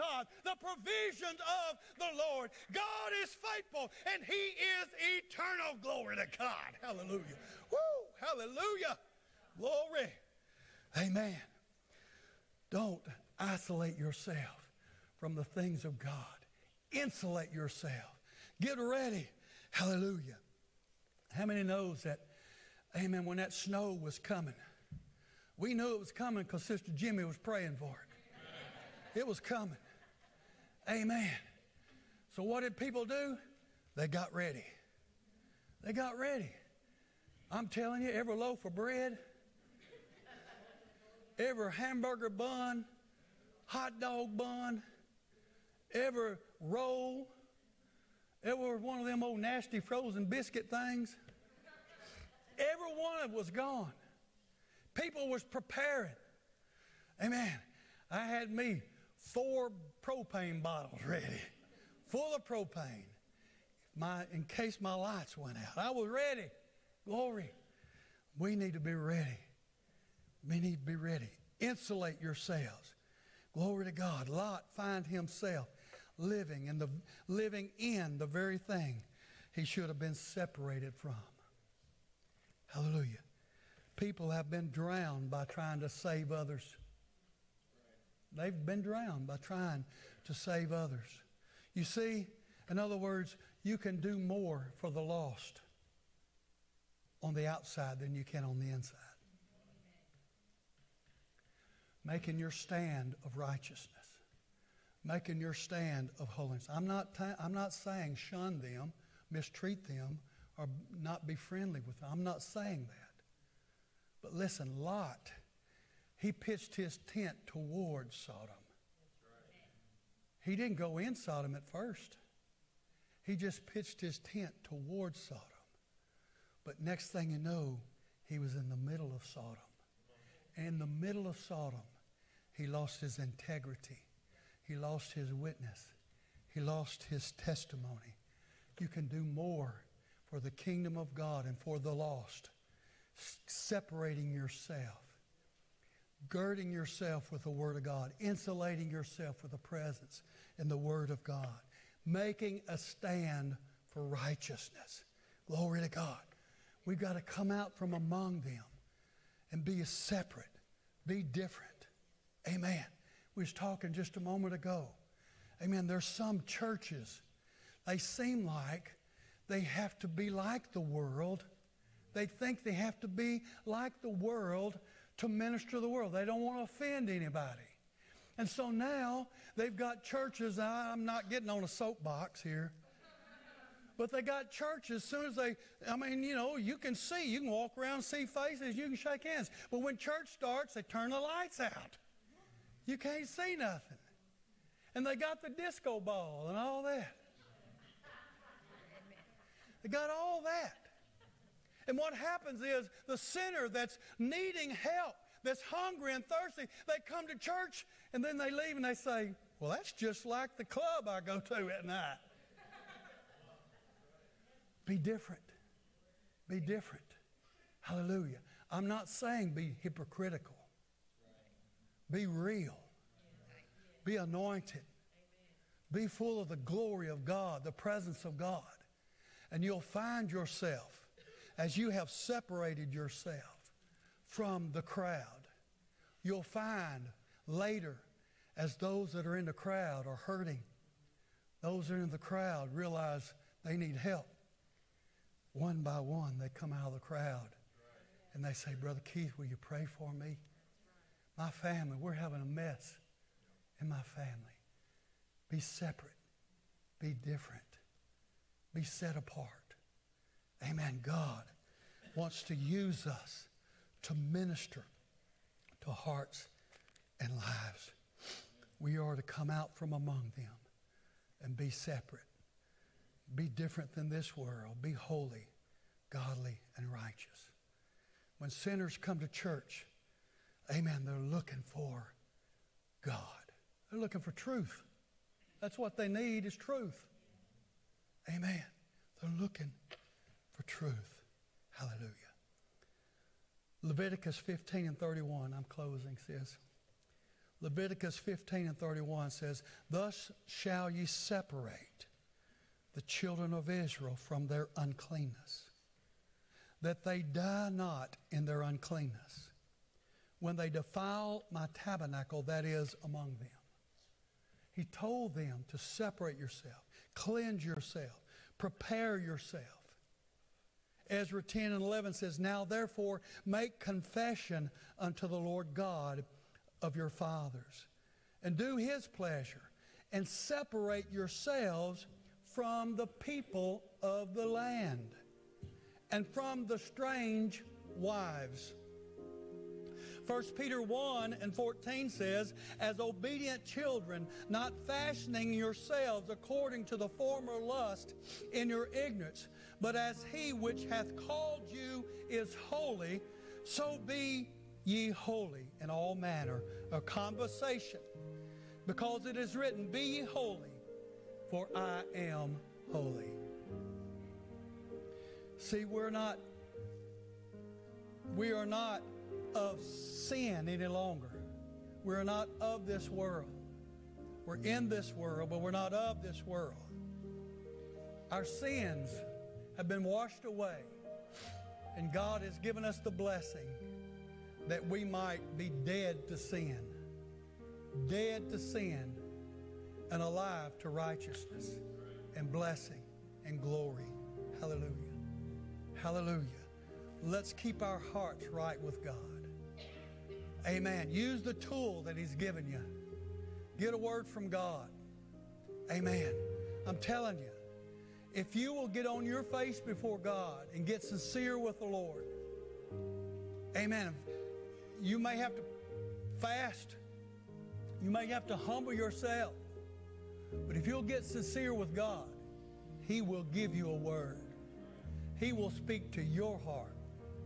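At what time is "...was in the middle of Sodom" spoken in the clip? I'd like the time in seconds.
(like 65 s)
128 s.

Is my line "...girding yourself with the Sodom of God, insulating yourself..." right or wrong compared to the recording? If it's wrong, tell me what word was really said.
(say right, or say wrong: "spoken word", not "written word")
wrong: "Word", not "Sodom".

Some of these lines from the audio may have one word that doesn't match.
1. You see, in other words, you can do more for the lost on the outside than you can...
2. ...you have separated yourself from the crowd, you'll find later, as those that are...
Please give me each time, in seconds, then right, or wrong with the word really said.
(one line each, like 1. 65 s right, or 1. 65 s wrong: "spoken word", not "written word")
1. 91 s right
2. 231 s right.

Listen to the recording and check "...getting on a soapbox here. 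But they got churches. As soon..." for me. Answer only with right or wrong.
right.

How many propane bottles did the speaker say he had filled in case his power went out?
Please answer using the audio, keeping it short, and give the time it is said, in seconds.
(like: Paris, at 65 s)
4, at 59 s.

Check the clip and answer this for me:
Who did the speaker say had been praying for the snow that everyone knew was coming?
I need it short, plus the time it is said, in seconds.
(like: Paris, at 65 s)
Sister Jimmy, at 26 s.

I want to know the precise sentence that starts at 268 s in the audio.
We are to come out from among them and be separate.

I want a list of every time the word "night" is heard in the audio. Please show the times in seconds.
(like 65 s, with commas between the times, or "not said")
211 s.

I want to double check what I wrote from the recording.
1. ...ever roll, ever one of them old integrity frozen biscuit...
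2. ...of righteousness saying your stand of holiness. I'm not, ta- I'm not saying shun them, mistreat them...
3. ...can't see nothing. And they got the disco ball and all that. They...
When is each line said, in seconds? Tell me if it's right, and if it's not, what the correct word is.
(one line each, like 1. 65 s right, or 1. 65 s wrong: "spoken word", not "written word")
1. 45 s wrong: "nasty", not "integrity"
2. 103 s wrong: "making", not "saying"
3. 192 s right.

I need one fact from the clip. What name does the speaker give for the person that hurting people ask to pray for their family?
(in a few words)
Brother Keith.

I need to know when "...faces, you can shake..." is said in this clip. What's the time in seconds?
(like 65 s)
188 s.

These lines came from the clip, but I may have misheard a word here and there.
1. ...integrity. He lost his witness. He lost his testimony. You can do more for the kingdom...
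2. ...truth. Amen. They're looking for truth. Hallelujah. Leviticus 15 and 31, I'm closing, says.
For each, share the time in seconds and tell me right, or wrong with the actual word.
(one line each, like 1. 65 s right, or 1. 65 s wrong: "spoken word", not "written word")
1. 133 s right
2. 286 s right.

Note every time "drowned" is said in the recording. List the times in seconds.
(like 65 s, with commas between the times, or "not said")
84 s, 88 s.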